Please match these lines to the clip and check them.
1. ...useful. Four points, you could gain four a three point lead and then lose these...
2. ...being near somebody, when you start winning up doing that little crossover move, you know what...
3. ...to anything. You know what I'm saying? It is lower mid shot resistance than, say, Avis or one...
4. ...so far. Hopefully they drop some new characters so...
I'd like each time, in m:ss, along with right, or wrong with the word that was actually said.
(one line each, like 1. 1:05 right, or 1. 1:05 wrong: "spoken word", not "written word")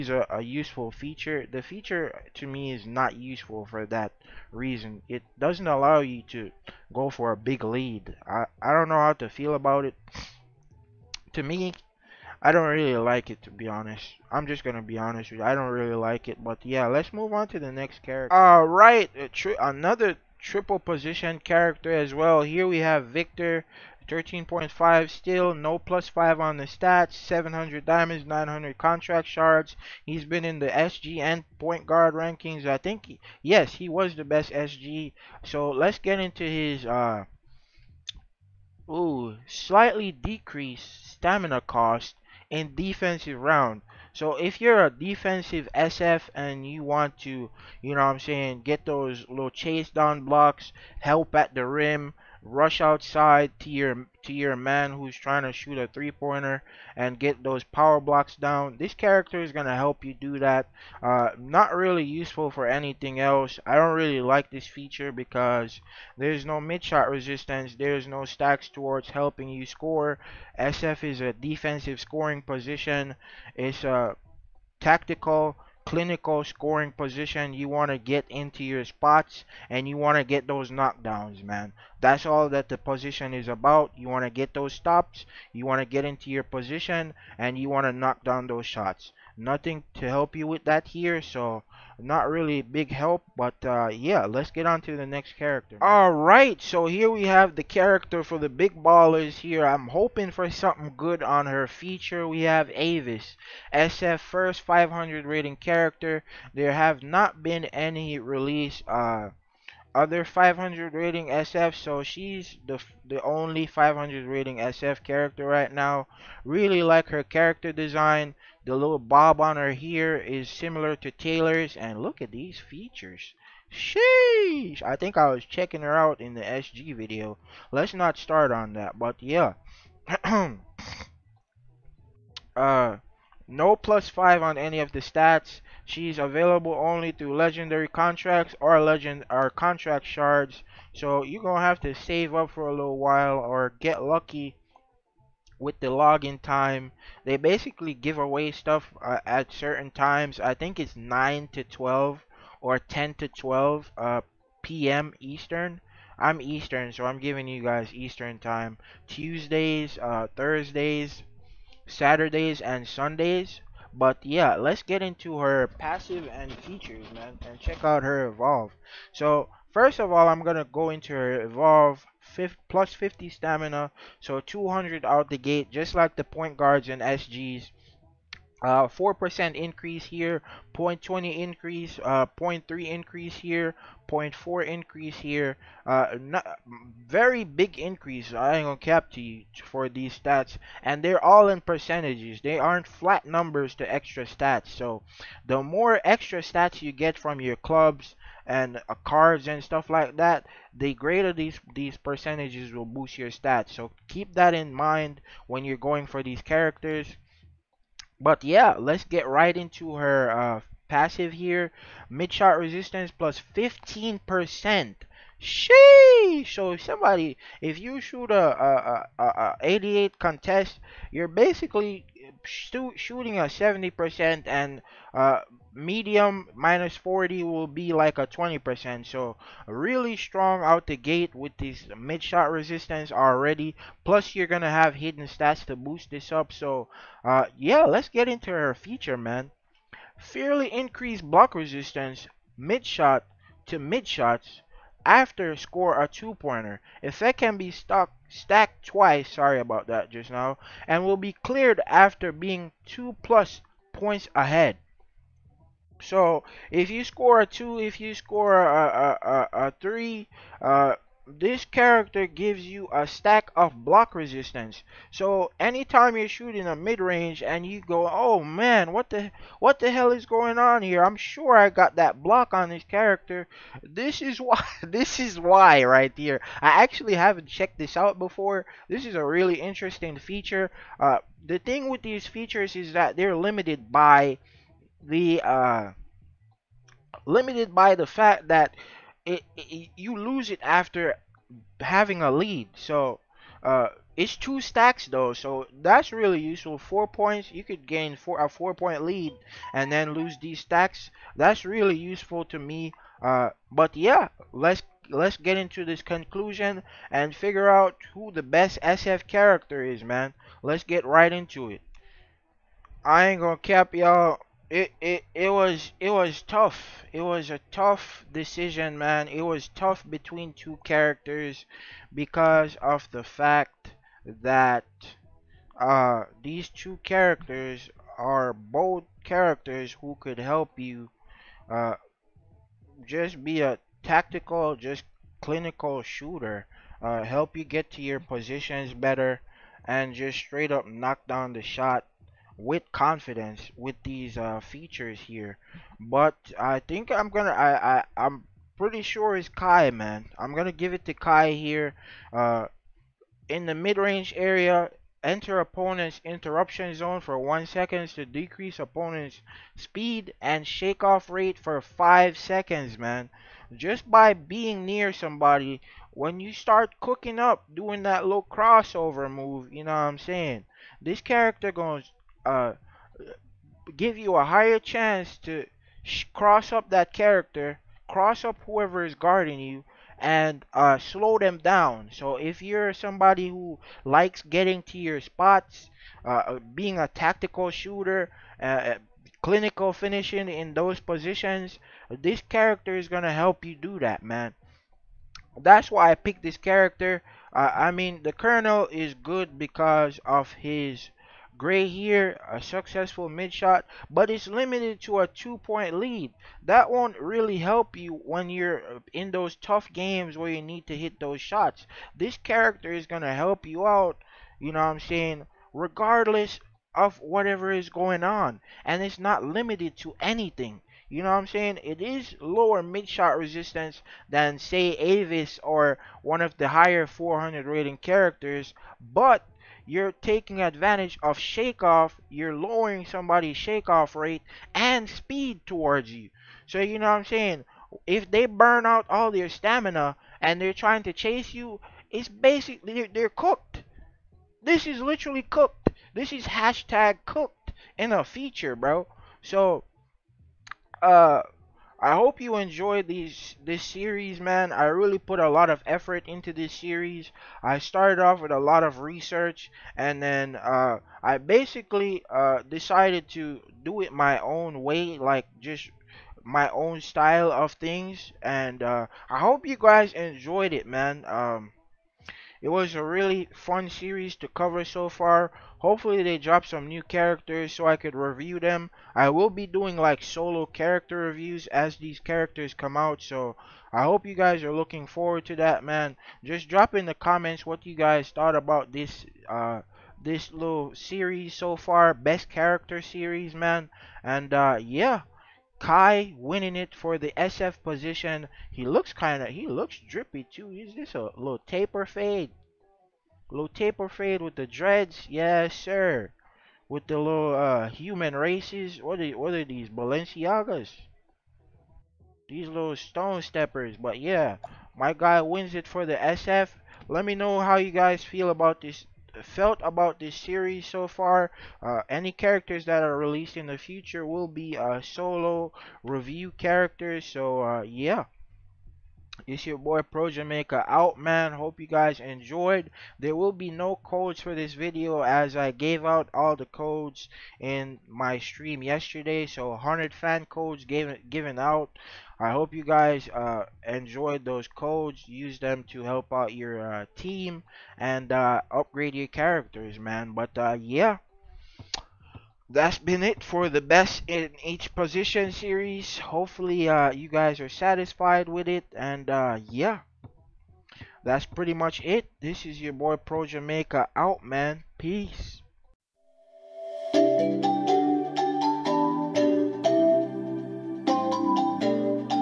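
1. 4:56 wrong: "four", not "three"
2. 6:04 wrong: "cooking", not "winning"
3. 6:59 right
4. 7:54 right.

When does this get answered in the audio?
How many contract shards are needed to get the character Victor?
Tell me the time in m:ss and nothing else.
0:28.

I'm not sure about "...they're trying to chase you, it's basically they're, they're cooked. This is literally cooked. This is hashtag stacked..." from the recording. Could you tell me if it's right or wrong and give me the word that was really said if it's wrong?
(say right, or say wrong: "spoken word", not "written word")
wrong: "cooked", not "stacked".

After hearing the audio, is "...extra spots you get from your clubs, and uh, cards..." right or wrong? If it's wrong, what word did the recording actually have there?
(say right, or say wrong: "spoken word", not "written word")
wrong: "stats", not "spots".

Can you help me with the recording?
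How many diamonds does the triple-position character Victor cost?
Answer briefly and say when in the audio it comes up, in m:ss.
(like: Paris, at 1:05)
700, at 0:27.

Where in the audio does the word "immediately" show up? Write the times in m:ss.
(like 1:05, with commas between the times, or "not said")
not said.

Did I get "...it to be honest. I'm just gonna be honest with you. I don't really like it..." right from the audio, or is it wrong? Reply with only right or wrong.
right.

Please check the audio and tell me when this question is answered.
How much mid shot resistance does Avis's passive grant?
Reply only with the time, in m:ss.
3:33.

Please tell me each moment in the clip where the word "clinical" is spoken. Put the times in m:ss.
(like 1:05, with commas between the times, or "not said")
1:15, 5:35, 6:29.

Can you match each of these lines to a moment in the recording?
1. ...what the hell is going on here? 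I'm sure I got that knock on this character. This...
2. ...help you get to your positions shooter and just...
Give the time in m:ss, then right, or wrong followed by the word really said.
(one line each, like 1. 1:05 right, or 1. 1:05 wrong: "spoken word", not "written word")
1. 4:29 wrong: "block", not "knock"
2. 5:37 wrong: "better", not "shooter".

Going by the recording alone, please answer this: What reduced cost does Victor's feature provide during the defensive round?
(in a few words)
stamina cost.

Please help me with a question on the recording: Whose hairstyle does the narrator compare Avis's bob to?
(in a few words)
Taylor's.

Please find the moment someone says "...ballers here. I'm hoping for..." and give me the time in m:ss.
1:38.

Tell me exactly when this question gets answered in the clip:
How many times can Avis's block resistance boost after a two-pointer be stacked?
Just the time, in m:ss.
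4:08.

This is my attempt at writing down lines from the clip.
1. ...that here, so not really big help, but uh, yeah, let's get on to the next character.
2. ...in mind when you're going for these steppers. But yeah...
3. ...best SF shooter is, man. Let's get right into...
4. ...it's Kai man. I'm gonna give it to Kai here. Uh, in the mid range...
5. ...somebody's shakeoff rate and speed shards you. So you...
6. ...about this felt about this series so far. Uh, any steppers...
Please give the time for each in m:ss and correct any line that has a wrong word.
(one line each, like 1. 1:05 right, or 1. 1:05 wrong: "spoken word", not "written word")
1. 1:30 right
2. 3:24 wrong: "characters", not "steppers"
3. 5:08 wrong: "character", not "shooter"
4. 5:49 right
5. 7:13 wrong: "towards", not "shards"
6. 8:38 wrong: "characters", not "steppers".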